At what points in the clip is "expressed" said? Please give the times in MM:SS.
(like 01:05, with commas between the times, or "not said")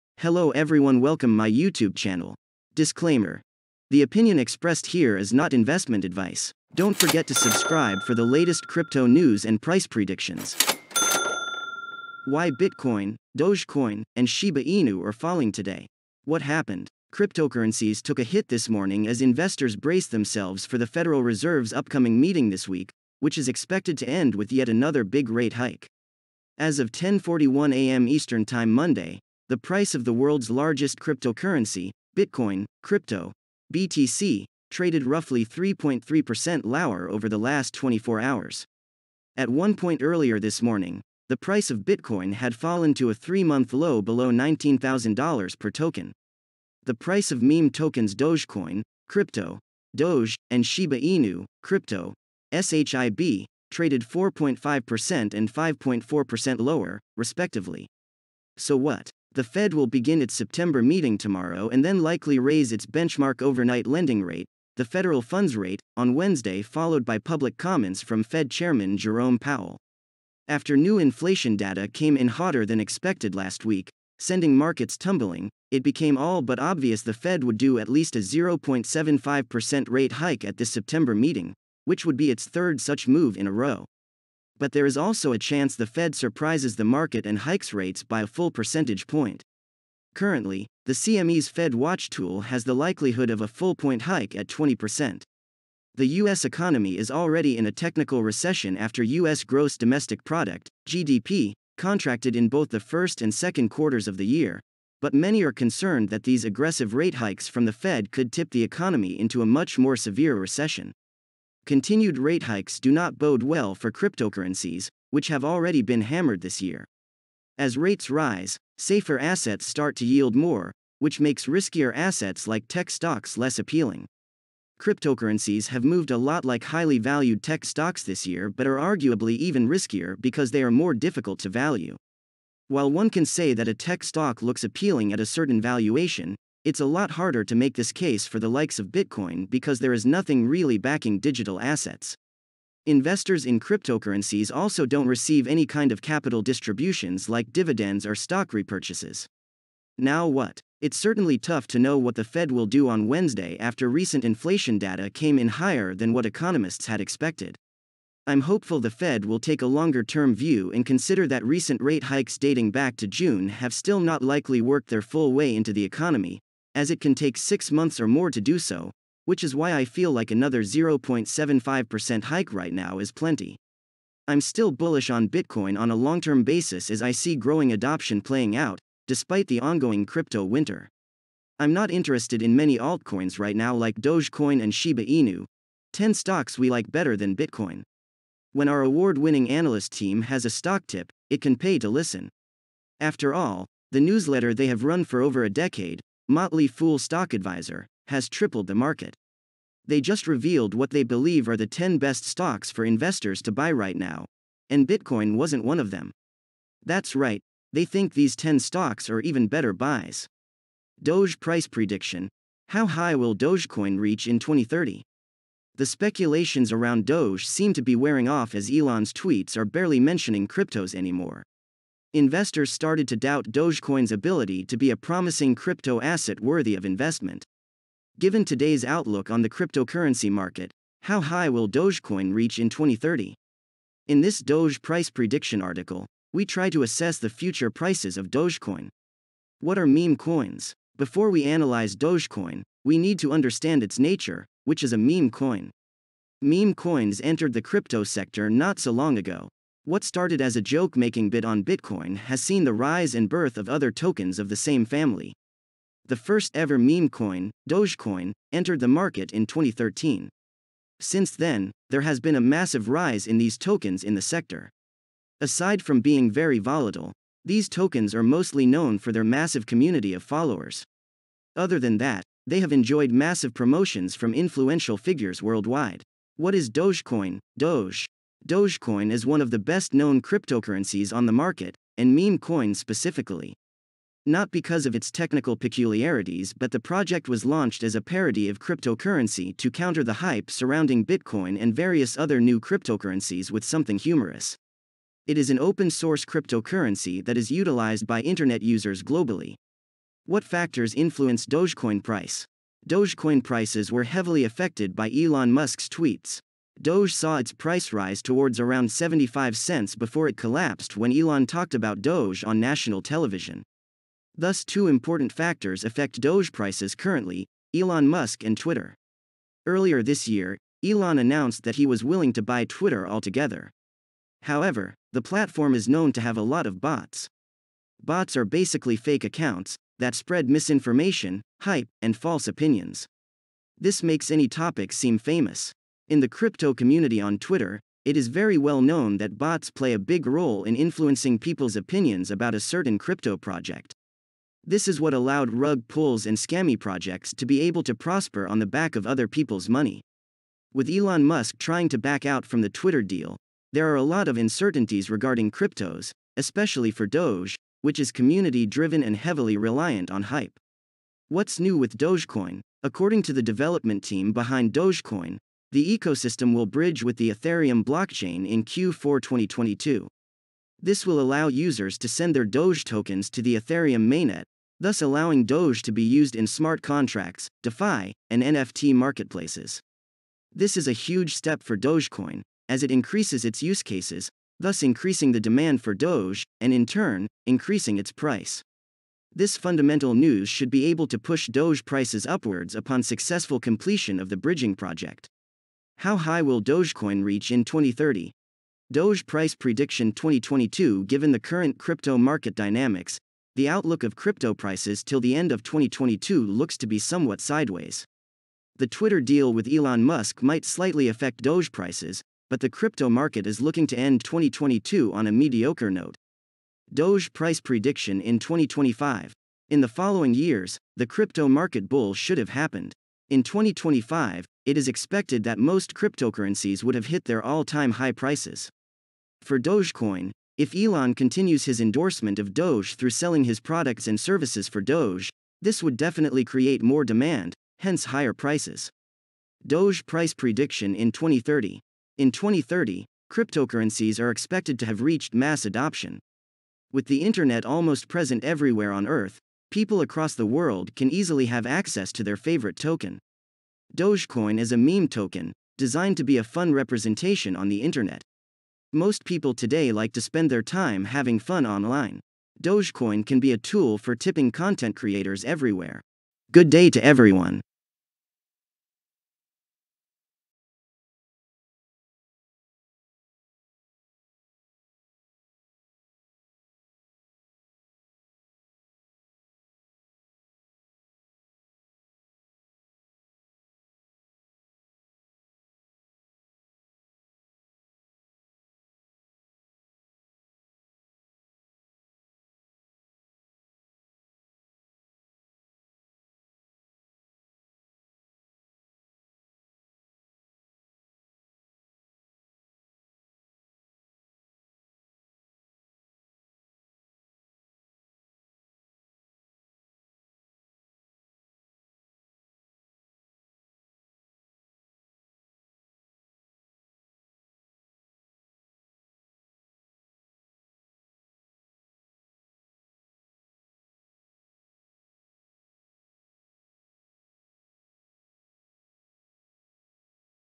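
00:04.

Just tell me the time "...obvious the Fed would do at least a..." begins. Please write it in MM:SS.
01:16.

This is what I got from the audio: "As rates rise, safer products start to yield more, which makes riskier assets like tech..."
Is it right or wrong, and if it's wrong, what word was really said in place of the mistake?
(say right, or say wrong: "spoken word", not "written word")
wrong: "assets", not "products".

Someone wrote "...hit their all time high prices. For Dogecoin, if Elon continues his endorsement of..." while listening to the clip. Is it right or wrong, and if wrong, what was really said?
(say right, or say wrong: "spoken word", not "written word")
right.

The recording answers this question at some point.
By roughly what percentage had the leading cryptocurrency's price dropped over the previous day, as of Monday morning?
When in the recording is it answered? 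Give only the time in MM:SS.
00:35.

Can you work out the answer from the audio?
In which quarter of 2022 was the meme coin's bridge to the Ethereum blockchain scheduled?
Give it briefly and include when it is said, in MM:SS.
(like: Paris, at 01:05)
Q4, at 06:08.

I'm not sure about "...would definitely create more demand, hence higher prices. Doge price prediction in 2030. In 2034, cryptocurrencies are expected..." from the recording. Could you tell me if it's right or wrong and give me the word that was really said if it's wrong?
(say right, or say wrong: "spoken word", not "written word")
wrong: "2030", not "2034".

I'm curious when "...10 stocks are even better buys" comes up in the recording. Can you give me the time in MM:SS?
03:28.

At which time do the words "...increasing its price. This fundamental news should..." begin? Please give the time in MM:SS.
06:27.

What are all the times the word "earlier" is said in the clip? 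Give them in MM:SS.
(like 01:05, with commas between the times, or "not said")
00:40, 05:19.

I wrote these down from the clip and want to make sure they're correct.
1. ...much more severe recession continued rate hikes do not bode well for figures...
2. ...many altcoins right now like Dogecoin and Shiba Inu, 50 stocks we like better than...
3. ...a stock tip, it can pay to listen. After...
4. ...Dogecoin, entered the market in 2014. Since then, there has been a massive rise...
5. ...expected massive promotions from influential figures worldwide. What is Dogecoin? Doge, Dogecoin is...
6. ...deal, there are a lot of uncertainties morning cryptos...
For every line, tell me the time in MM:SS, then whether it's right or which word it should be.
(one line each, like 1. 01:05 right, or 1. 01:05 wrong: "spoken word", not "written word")
1. 01:49 wrong: "cryptocurrencies", not "figures"
2. 03:02 wrong: "10", not "50"
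3. 03:10 right
4. 04:17 wrong: "2013", not "2014"
5. 04:32 wrong: "enjoyed", not "expected"
6. 05:53 wrong: "regarding", not "morning".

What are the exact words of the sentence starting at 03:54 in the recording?
In this Doge price prediction article, we try to assess the future prices of Dogecoin.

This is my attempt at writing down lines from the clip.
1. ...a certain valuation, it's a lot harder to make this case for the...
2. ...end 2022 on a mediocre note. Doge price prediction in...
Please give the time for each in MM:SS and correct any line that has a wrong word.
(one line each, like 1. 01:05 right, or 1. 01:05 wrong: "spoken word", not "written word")
1. 02:15 right
2. 06:53 right.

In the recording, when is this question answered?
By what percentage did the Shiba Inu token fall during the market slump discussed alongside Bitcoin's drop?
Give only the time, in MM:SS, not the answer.
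00:55.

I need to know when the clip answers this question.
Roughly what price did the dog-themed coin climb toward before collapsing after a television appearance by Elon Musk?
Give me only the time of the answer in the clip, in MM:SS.
05:08.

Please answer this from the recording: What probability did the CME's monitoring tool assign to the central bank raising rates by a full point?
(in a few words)
20%.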